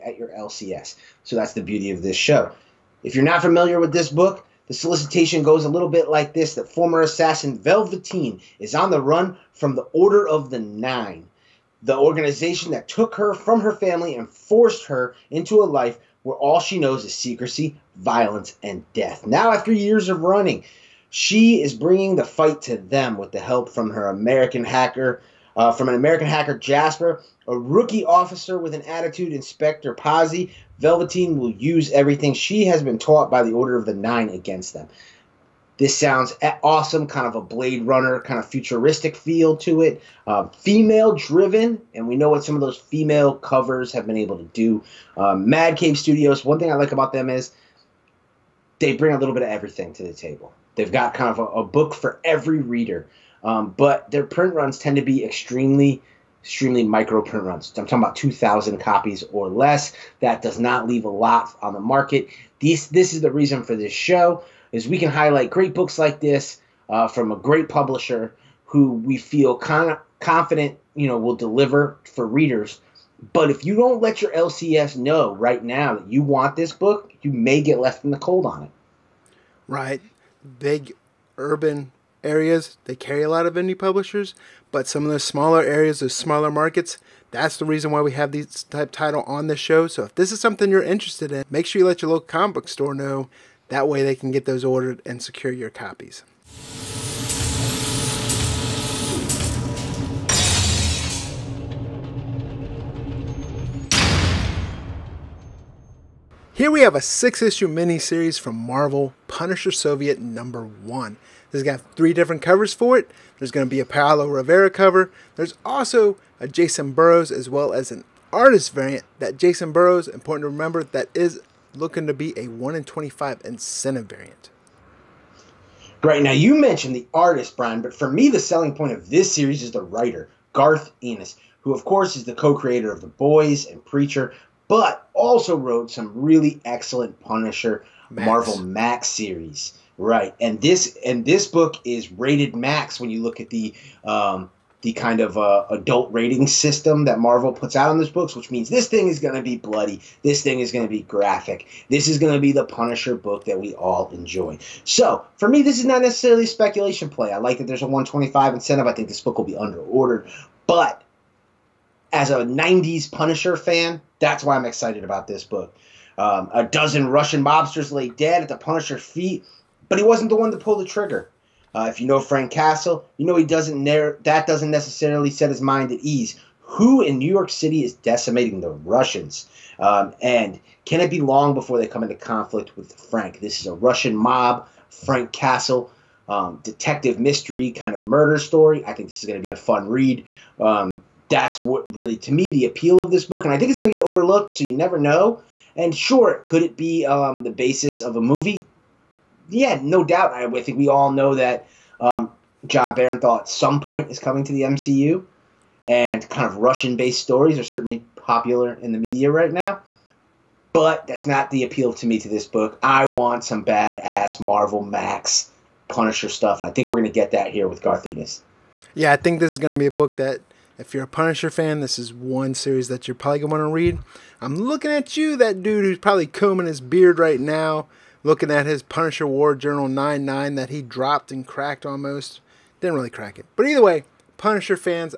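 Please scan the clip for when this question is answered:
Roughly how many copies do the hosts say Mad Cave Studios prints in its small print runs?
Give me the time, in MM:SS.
00:58.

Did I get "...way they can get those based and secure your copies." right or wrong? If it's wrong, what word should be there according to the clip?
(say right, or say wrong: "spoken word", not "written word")
wrong: "ordered", not "based".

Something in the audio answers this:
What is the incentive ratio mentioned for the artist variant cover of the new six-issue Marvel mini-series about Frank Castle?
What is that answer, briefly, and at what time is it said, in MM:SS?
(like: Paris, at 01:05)
1 in 25, at 02:02.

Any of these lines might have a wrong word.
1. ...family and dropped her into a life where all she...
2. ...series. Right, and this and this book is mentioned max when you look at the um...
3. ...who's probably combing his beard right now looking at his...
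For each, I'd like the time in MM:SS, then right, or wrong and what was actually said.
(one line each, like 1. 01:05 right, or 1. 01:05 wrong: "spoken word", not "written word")
1. 00:13 wrong: "forced", not "dropped"
2. 02:19 wrong: "rated", not "mentioned"
3. 03:45 right.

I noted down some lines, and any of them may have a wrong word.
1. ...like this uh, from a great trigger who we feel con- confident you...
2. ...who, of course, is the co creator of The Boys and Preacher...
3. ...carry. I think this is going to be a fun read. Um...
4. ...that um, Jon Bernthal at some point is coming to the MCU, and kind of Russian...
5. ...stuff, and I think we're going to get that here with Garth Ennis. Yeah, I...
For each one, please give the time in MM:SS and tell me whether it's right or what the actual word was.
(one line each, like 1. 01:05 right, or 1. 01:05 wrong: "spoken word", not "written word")
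1. 01:05 wrong: "publisher", not "trigger"
2. 02:11 right
3. 03:08 wrong: "story", not "carry"
4. 03:21 right
5. 03:36 right.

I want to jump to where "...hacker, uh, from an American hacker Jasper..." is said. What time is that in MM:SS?
00:24.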